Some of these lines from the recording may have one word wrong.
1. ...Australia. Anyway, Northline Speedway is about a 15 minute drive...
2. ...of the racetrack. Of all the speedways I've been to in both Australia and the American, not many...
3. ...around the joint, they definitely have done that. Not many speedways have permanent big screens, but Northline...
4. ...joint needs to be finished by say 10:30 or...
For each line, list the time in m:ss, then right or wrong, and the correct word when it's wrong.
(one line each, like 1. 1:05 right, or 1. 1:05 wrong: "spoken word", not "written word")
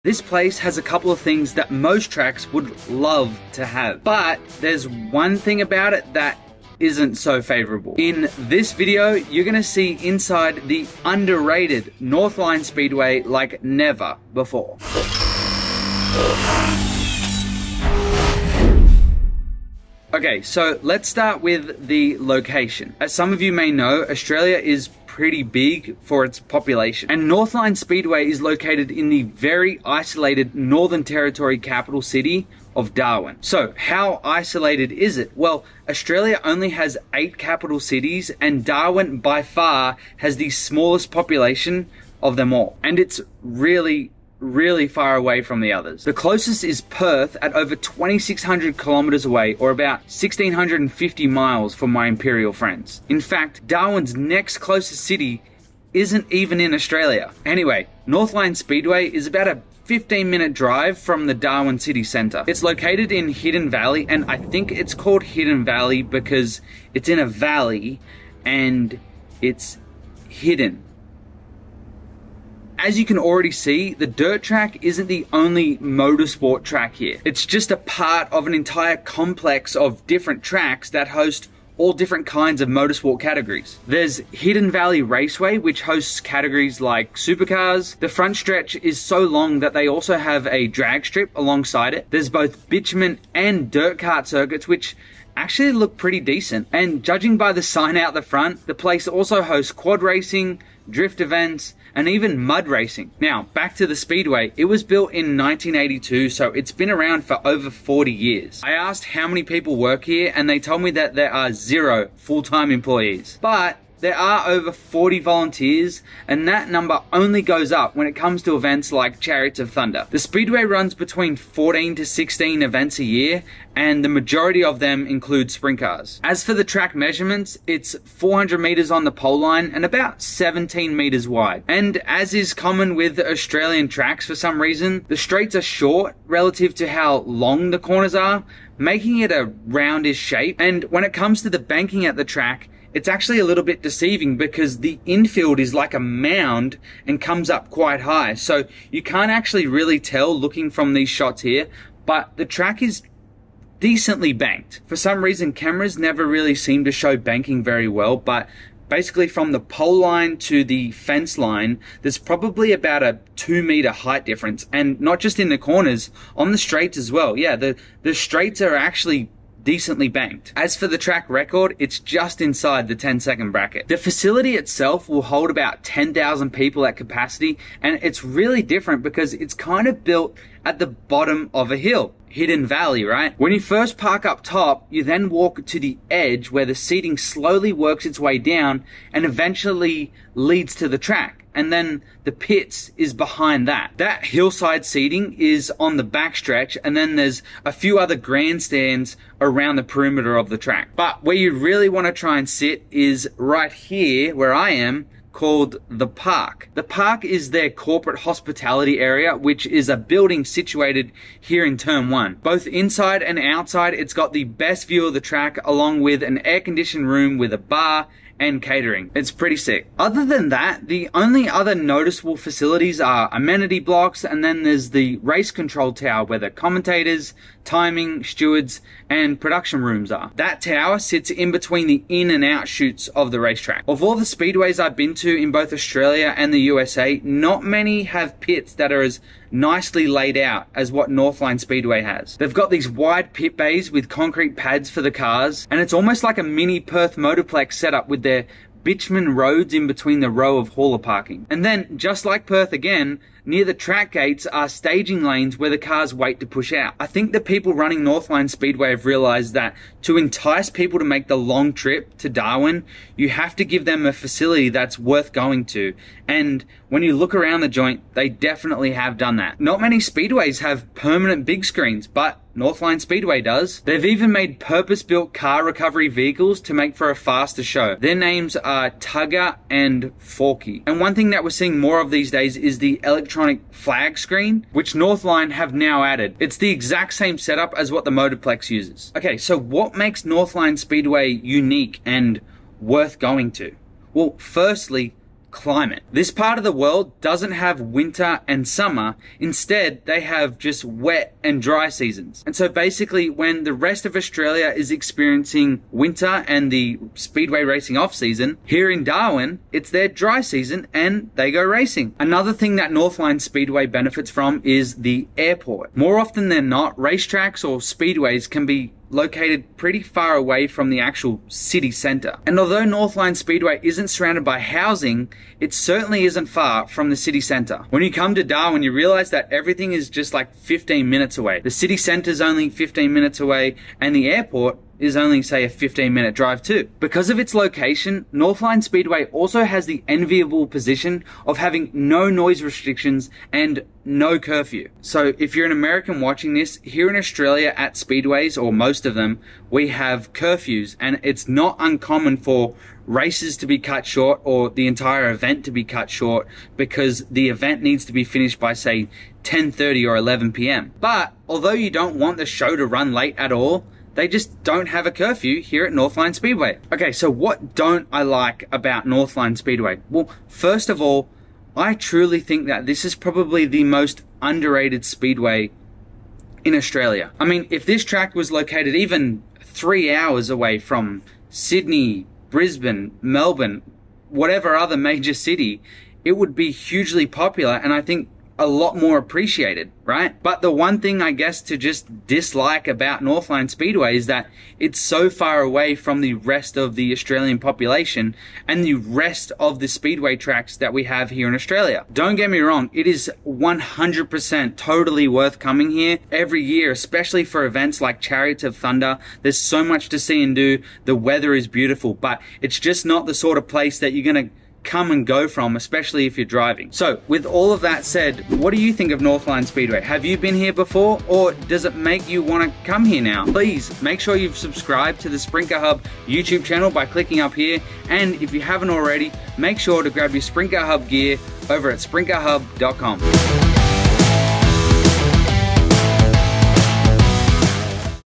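1. 0:56 right
2. 3:53 wrong: "USA", not "American"
3. 4:27 right
4. 5:57 wrong: "event", not "joint".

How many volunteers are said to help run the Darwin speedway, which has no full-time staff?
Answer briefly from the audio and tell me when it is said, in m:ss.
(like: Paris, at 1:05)
over 40, at 1:54.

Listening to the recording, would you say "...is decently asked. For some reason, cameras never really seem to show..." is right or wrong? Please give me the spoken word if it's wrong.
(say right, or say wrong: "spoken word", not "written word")
wrong: "banked", not "asked".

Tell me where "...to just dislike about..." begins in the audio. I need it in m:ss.
6:31.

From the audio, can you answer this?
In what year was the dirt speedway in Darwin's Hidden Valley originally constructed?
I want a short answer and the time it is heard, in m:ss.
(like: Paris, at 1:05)
1982, at 1:45.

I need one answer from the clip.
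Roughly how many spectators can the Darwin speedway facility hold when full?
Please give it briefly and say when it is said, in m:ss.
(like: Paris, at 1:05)
10,000, at 2:55.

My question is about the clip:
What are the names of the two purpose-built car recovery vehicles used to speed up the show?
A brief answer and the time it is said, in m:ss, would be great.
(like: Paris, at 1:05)
Tugger and Forky, at 4:38.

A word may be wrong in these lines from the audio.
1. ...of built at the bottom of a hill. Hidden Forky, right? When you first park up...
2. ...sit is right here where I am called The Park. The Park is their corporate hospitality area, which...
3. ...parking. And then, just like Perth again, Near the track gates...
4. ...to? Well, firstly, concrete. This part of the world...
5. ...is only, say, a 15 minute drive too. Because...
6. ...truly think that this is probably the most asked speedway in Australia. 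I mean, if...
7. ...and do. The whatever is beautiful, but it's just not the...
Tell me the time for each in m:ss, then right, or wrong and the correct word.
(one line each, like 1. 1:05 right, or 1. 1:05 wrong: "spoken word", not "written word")
1. 2:59 wrong: "Valley", not "Forky"
2. 3:22 right
3. 4:10 right
4. 4:53 wrong: "climate", not "concrete"
5. 5:35 right
6. 6:11 wrong: "underrated", not "asked"
7. 6:50 wrong: "weather", not "whatever".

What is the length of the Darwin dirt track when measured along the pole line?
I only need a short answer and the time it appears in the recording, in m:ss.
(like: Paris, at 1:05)
400 meters, at 2:08.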